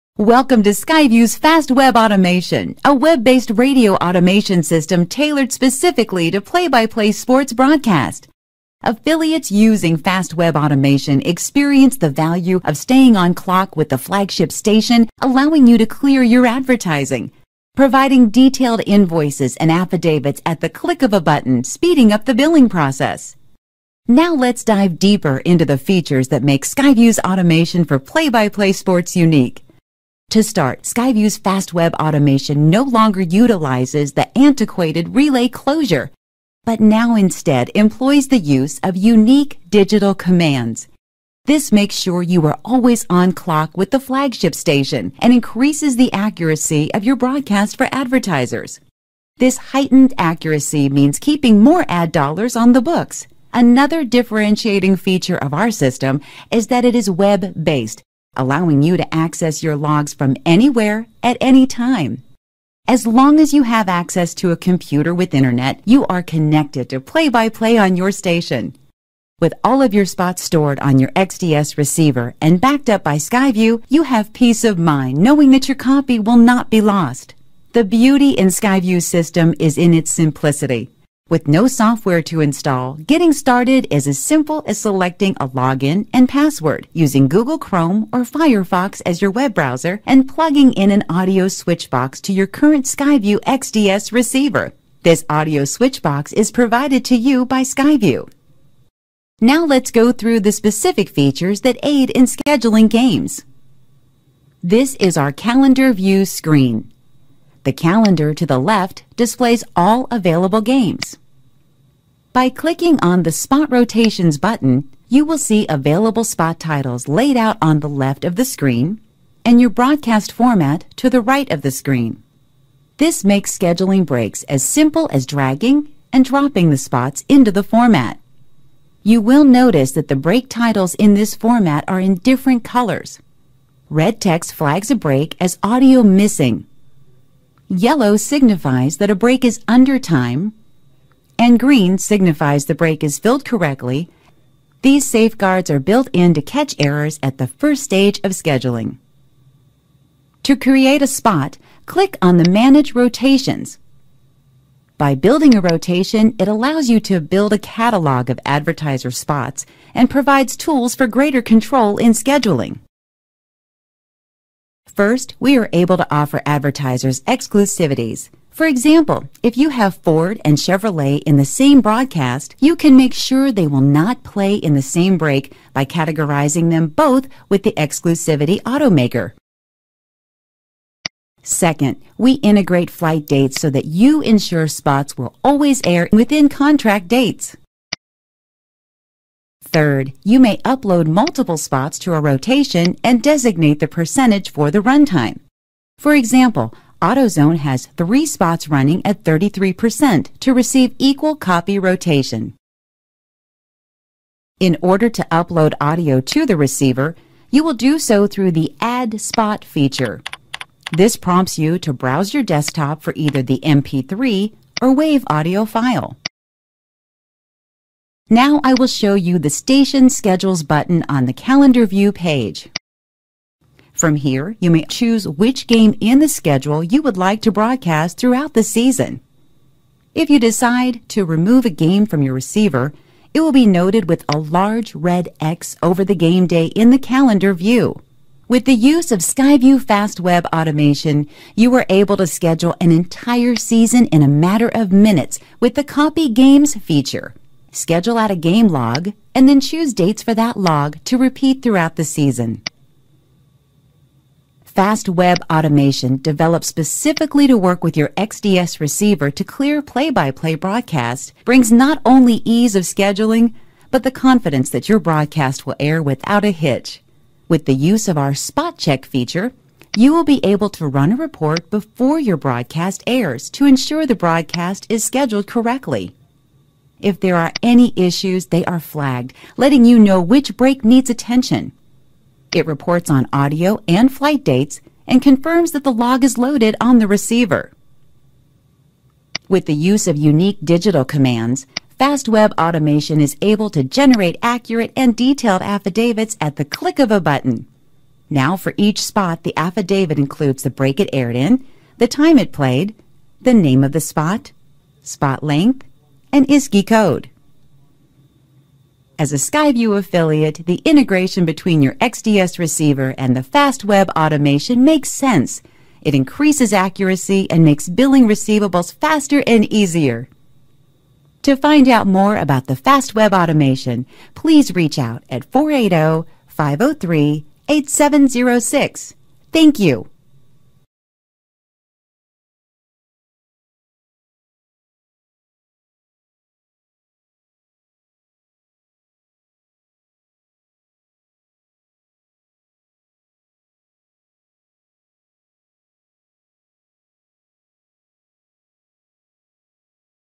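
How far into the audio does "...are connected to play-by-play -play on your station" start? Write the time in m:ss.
1:06.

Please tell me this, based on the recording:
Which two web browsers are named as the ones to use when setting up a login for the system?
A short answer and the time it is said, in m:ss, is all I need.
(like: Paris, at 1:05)
Google Chrome or Firefox, at 1:27.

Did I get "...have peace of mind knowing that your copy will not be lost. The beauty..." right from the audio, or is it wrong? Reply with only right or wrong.
right.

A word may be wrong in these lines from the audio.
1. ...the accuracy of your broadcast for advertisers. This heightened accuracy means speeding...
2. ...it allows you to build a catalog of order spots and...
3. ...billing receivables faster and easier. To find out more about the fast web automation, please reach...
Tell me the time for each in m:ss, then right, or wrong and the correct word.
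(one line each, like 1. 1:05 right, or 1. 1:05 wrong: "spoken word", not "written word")
1. 0:45 wrong: "keeping", not "speeding"
2. 2:36 wrong: "advertiser", not "order"
3. 5:17 right.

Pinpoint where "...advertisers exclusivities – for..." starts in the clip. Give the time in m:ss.
2:46.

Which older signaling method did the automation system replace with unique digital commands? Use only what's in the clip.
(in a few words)
relay closure.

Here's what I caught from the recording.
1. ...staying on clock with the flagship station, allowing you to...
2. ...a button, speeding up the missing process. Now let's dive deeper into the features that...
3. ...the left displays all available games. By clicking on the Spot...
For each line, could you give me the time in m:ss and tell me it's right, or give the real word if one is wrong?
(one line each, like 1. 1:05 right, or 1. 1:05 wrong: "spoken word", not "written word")
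1. 0:12 right
2. 0:21 wrong: "billing", not "missing"
3. 1:48 right.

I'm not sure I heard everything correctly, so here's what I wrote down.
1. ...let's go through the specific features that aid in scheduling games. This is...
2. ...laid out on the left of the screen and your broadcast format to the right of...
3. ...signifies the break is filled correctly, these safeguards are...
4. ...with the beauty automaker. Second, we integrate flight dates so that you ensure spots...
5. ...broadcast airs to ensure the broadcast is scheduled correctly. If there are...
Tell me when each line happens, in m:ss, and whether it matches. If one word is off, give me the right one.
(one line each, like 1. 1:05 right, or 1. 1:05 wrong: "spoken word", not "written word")
1. 1:39 right
2. 1:57 right
3. 2:21 right
4. 2:57 wrong: "exclusivity", not "beauty"
5. 4:32 right.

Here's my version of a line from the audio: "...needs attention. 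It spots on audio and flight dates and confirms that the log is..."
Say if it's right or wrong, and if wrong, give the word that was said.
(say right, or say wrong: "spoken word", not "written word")
wrong: "reports", not "spots".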